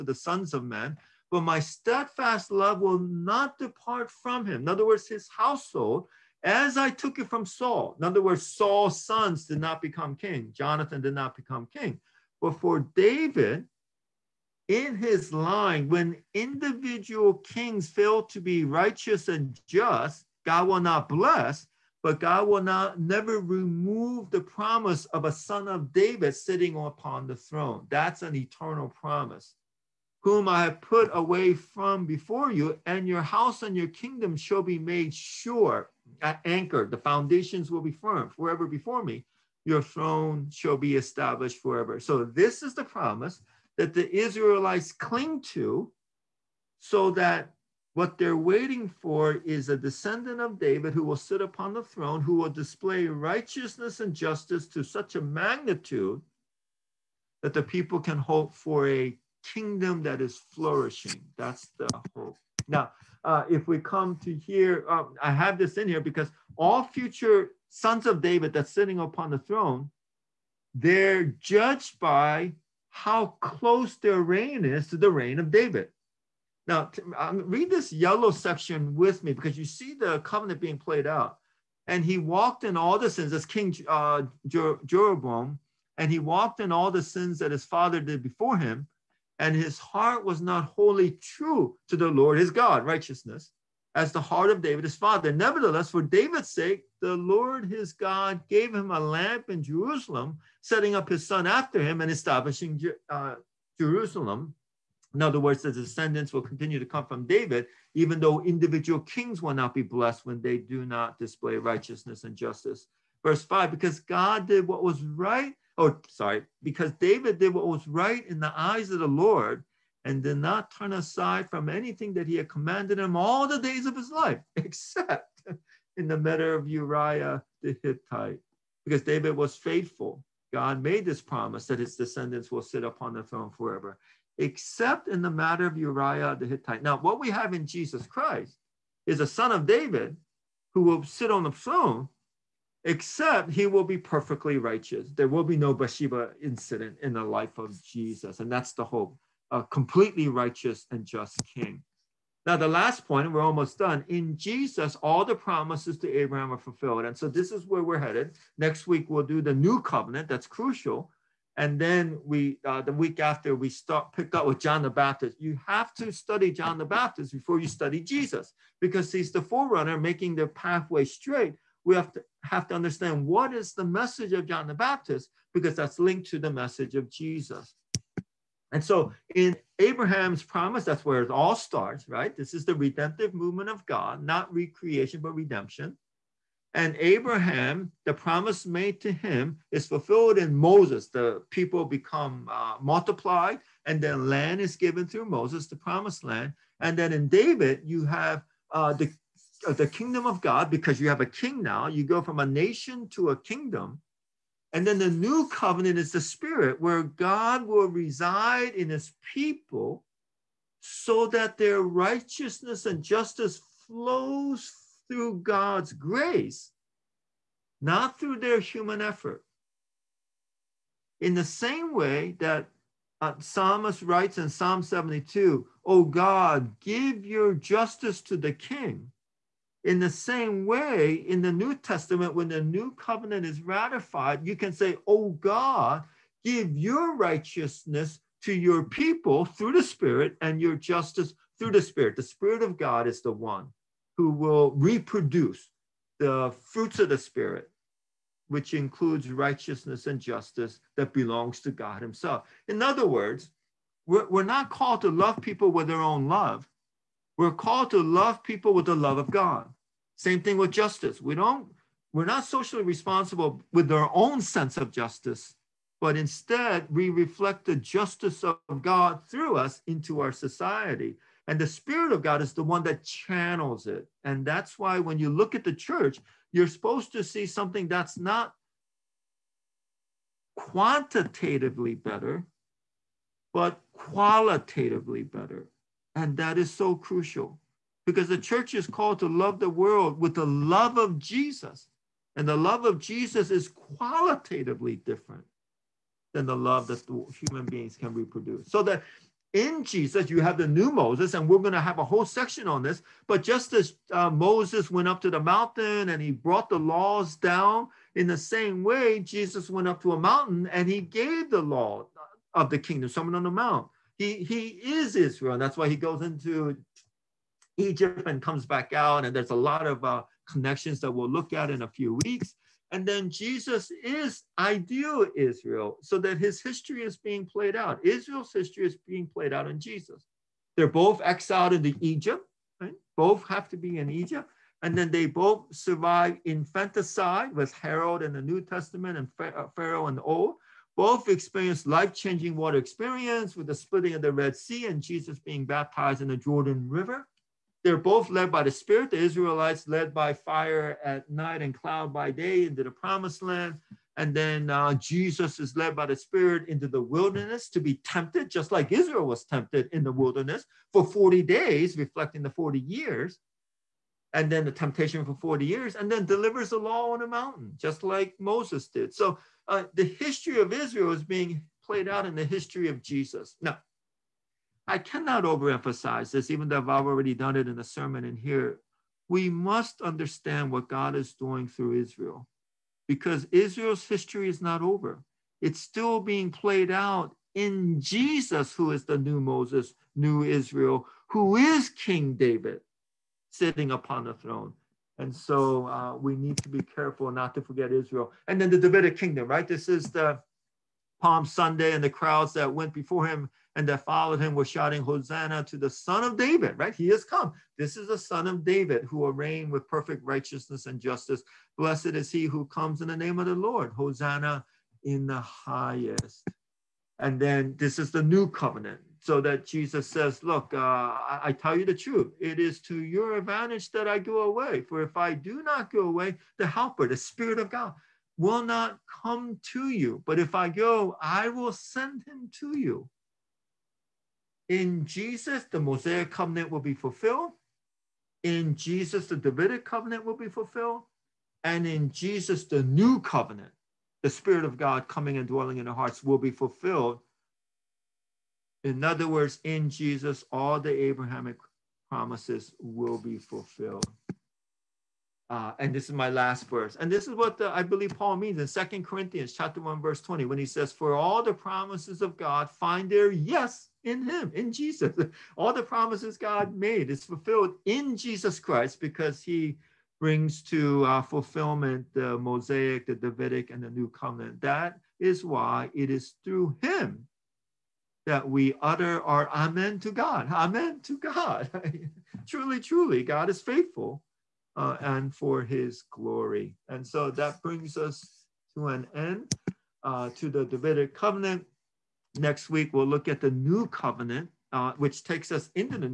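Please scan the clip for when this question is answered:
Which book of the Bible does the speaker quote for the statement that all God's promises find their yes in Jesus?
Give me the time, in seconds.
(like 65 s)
458 s.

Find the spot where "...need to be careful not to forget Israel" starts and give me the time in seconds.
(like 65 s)
396 s.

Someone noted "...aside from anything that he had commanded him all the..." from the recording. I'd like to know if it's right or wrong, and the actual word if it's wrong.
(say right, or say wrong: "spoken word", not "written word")
right.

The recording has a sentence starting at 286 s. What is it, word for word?
And that is so crucial because the church is called to love the world with the love of Jesus.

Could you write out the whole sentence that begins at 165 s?
You have to study John the Baptist before you study Jesus, because he's the forerunner, making the pathway straight.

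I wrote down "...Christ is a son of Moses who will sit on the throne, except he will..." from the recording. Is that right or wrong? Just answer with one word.
wrong.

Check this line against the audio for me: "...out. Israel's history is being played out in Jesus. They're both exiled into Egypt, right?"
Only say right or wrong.
right.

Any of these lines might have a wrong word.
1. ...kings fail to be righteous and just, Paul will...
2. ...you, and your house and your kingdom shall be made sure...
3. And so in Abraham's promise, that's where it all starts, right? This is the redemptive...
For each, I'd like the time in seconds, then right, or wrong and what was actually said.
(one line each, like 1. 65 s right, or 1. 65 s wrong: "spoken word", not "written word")
1. 17 s wrong: "God", not "Paul"
2. 32 s right
3. 178 s right.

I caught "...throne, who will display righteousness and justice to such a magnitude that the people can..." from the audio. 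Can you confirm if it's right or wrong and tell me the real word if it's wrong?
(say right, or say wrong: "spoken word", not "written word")
right.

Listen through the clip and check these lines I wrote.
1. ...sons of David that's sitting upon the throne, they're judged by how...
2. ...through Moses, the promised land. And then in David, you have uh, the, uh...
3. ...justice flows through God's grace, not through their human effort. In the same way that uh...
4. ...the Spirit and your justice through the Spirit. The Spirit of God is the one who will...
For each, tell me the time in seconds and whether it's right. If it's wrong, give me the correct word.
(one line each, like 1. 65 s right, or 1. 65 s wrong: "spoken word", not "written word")
1. 67 s right
2. 195 s right
3. 213 s right
4. 239 s right.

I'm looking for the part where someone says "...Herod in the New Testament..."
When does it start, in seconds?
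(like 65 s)
337 s.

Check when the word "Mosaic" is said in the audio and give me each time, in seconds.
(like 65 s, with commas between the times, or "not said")
435 s, 472 s.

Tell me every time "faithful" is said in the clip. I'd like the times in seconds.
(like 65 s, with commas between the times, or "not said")
129 s, 483 s.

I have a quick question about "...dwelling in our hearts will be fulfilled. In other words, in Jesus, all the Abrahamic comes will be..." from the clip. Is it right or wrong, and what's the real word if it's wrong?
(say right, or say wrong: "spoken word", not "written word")
wrong: "promises", not "comes".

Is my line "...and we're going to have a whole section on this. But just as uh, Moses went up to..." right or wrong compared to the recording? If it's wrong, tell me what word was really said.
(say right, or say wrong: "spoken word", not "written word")
right.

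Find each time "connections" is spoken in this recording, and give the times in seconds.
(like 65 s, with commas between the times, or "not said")
320 s.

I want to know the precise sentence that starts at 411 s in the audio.
Blessed is he who comes in the name of the Lord.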